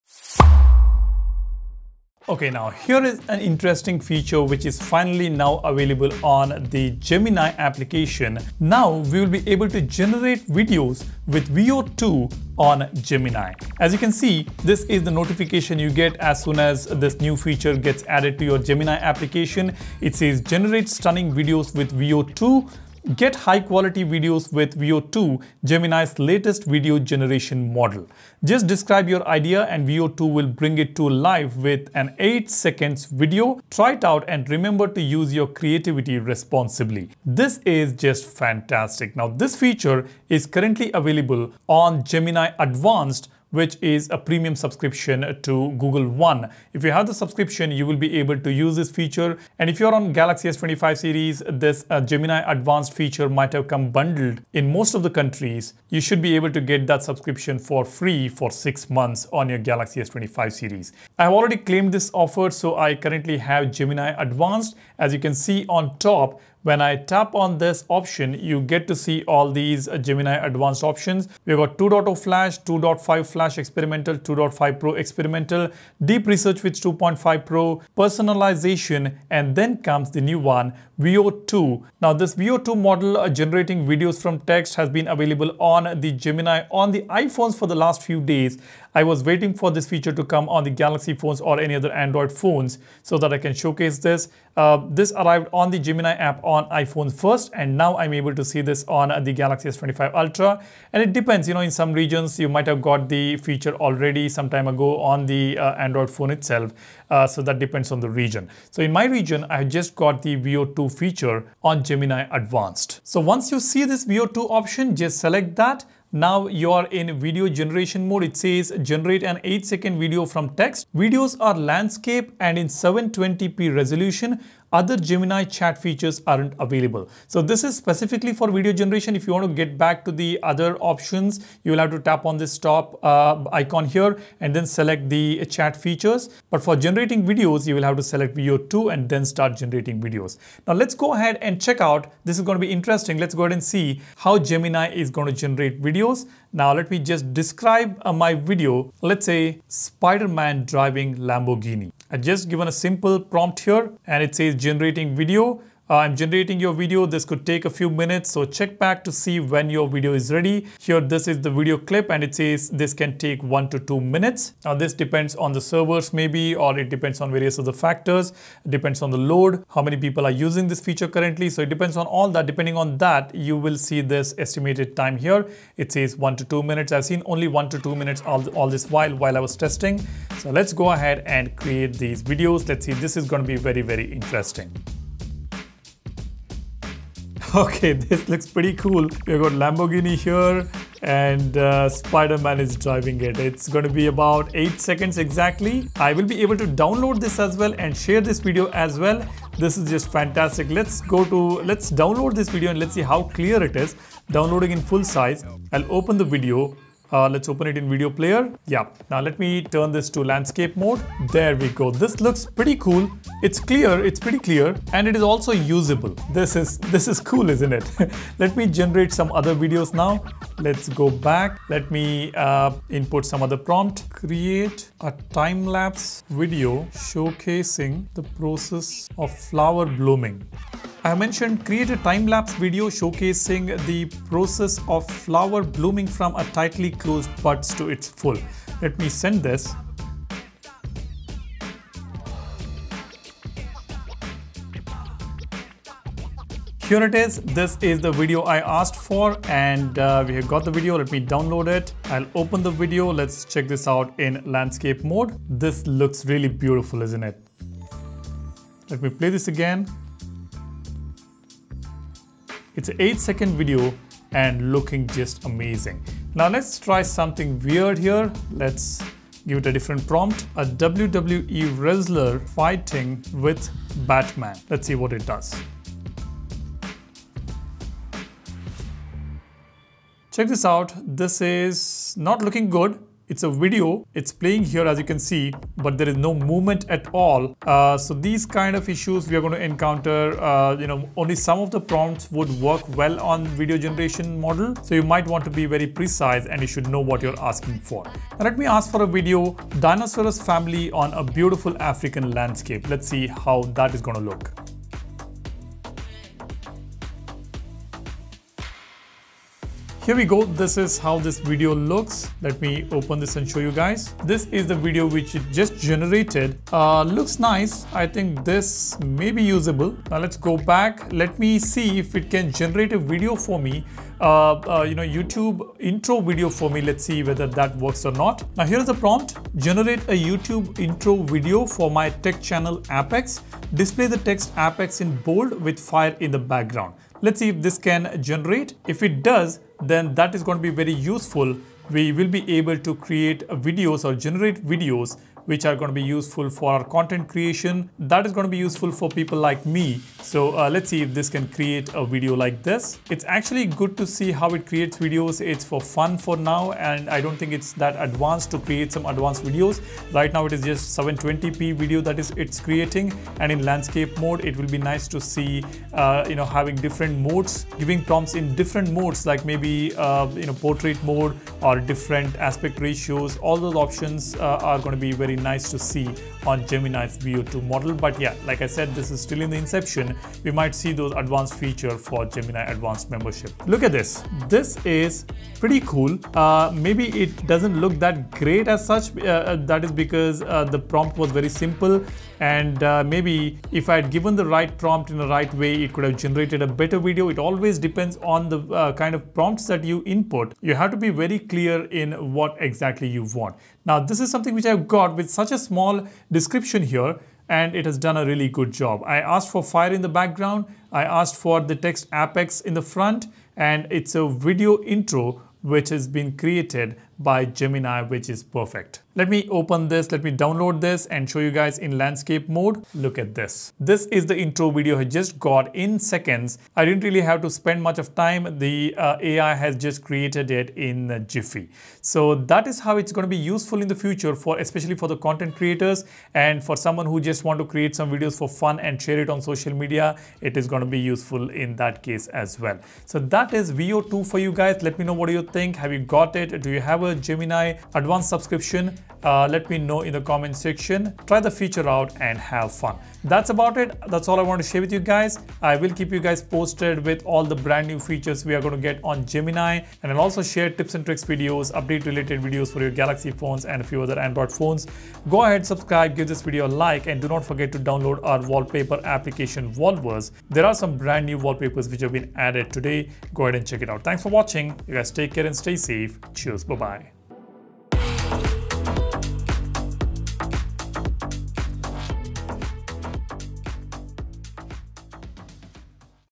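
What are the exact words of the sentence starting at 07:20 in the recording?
It is going to be useful in that case as well.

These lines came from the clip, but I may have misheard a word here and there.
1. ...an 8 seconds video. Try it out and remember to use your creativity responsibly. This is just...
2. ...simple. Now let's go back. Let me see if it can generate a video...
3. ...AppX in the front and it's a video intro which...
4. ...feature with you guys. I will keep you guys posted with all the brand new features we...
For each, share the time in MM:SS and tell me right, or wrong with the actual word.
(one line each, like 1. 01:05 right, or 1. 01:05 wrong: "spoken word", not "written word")
1. 00:31 right
2. 05:19 wrong: "usable", not "simple"
3. 06:52 right
4. 07:34 wrong: "share", not "feature".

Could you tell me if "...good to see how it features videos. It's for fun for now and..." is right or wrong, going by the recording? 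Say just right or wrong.
wrong.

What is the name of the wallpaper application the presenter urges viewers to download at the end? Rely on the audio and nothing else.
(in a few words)
Wallverse.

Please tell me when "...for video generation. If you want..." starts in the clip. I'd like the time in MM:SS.
02:08.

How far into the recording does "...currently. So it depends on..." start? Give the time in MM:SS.
02:51.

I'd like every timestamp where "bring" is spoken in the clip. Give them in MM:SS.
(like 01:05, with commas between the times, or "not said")
00:30.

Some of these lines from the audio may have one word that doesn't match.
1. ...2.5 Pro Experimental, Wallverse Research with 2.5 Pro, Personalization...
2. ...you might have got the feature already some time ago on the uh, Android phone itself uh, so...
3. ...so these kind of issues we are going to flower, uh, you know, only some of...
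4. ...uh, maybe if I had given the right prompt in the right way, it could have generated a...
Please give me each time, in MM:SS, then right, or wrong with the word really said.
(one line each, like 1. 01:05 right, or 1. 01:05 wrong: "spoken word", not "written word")
1. 01:14 wrong: "Deep", not "Wallverse"
2. 01:42 right
3. 04:47 wrong: "encounter", not "flower"
4. 06:32 right.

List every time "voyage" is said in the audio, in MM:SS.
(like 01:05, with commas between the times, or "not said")
not said.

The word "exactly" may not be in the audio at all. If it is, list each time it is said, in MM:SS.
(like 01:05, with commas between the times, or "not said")
03:15, 06:42.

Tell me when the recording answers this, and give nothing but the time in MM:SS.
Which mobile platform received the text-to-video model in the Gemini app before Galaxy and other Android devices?
01:25.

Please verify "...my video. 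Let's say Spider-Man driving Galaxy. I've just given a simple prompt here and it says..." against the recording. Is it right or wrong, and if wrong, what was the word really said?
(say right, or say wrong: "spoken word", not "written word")
wrong: "Lamborghini", not "Galaxy".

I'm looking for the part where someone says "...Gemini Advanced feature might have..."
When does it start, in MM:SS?
00:52.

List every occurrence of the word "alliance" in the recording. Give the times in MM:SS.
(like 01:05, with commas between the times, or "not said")
not said.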